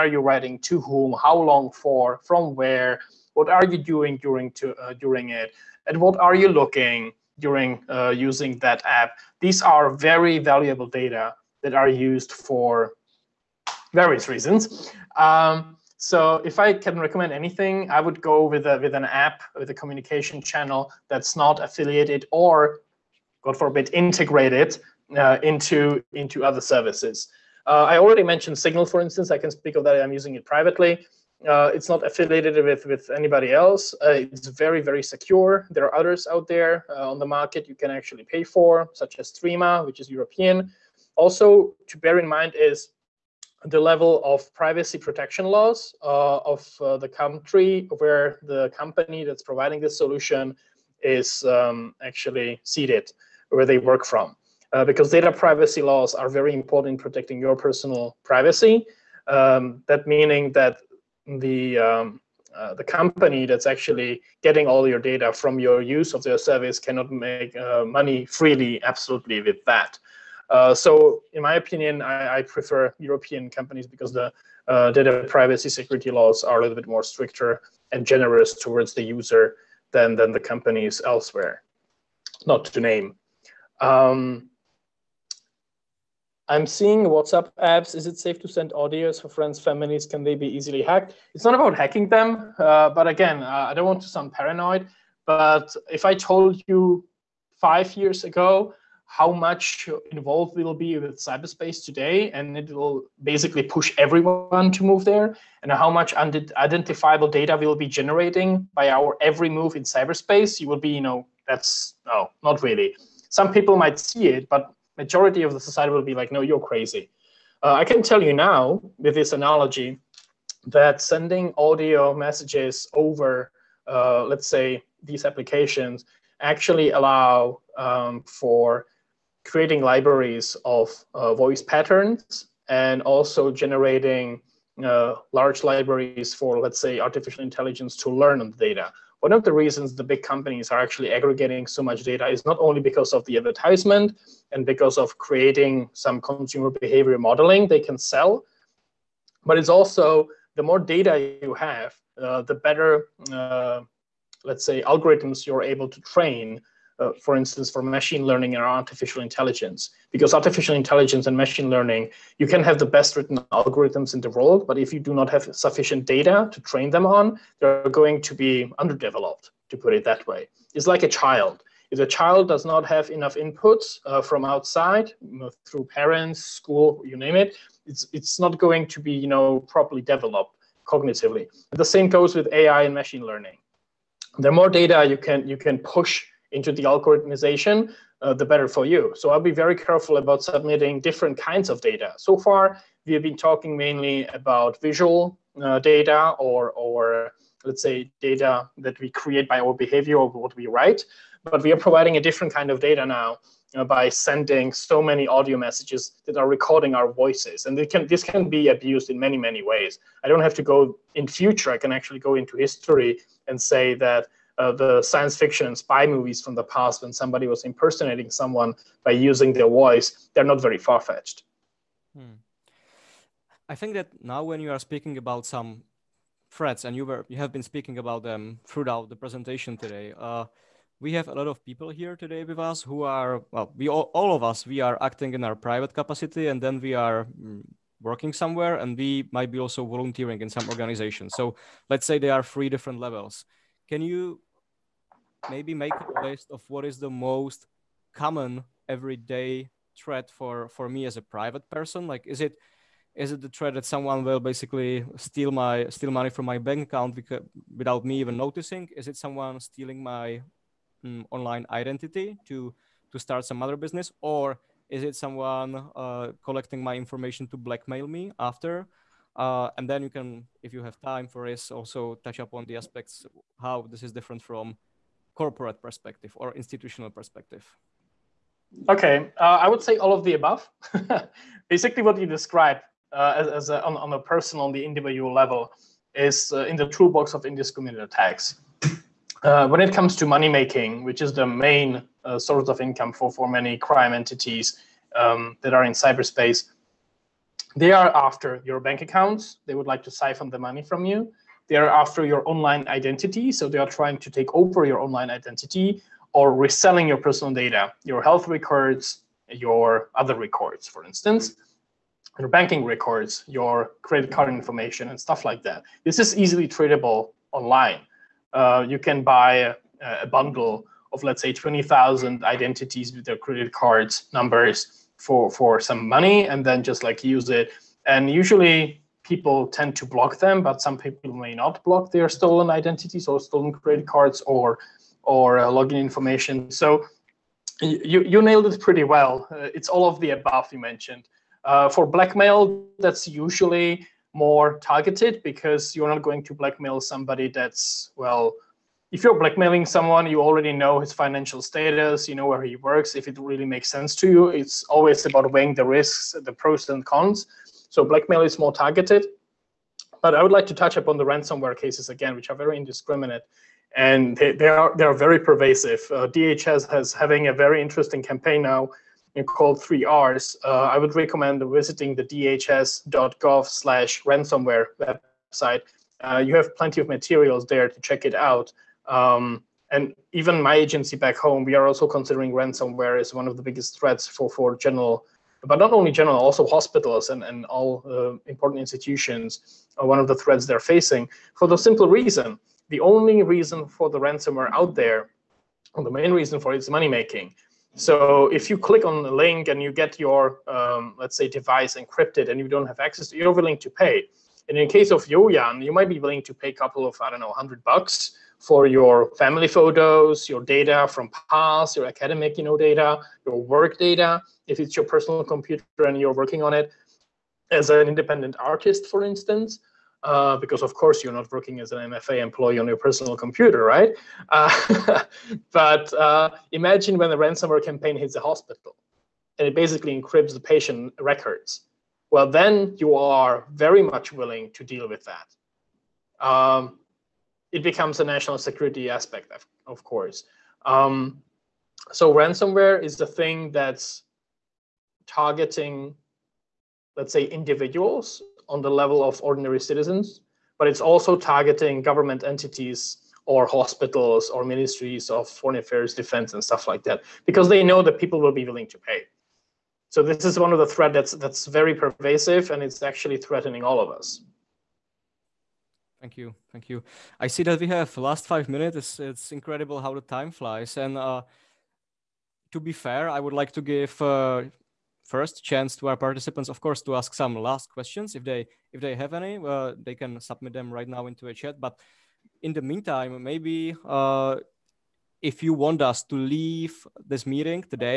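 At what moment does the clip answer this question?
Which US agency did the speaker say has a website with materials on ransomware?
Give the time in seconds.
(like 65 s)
366 s.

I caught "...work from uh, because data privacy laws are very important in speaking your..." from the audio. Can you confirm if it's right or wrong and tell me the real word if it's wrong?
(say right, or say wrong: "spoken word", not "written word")
wrong: "protecting", not "speaking".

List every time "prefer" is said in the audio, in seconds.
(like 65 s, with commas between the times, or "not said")
72 s.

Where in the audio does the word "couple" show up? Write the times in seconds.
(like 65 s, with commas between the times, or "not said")
406 s.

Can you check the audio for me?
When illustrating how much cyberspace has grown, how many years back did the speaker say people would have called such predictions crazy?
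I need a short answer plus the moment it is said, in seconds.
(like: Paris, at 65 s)
5 years, at 97 s.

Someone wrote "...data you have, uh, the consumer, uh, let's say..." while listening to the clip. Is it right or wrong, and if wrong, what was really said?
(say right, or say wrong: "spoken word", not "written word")
wrong: "better", not "consumer".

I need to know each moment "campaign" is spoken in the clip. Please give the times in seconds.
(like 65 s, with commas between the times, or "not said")
368 s, 427 s.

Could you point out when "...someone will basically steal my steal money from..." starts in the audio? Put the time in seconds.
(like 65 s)
253 s.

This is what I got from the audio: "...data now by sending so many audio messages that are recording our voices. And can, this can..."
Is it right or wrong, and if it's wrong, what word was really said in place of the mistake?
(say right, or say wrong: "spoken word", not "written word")
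right.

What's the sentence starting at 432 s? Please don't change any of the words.
Well, then you are very much willing to deal with that.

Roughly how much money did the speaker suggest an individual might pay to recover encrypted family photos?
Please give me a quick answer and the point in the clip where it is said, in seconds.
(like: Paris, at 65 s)
100 bucks, at 407 s.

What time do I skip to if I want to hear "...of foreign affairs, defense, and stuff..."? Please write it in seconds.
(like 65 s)
455 s.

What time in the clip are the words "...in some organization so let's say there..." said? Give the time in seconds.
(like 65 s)
240 s.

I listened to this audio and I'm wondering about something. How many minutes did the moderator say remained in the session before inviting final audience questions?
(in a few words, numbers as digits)
5 minutes.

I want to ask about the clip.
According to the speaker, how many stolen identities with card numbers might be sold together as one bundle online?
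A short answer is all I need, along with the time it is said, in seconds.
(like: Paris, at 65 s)
20,000, at 321 s.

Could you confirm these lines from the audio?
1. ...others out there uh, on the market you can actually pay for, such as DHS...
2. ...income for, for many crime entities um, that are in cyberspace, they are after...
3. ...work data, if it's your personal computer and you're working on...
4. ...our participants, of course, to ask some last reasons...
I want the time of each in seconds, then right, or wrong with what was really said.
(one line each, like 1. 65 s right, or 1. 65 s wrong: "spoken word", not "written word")
1. 35 s wrong: "Threema", not "DHS"
2. 292 s right
3. 413 s right
4. 476 s wrong: "questions", not "reasons".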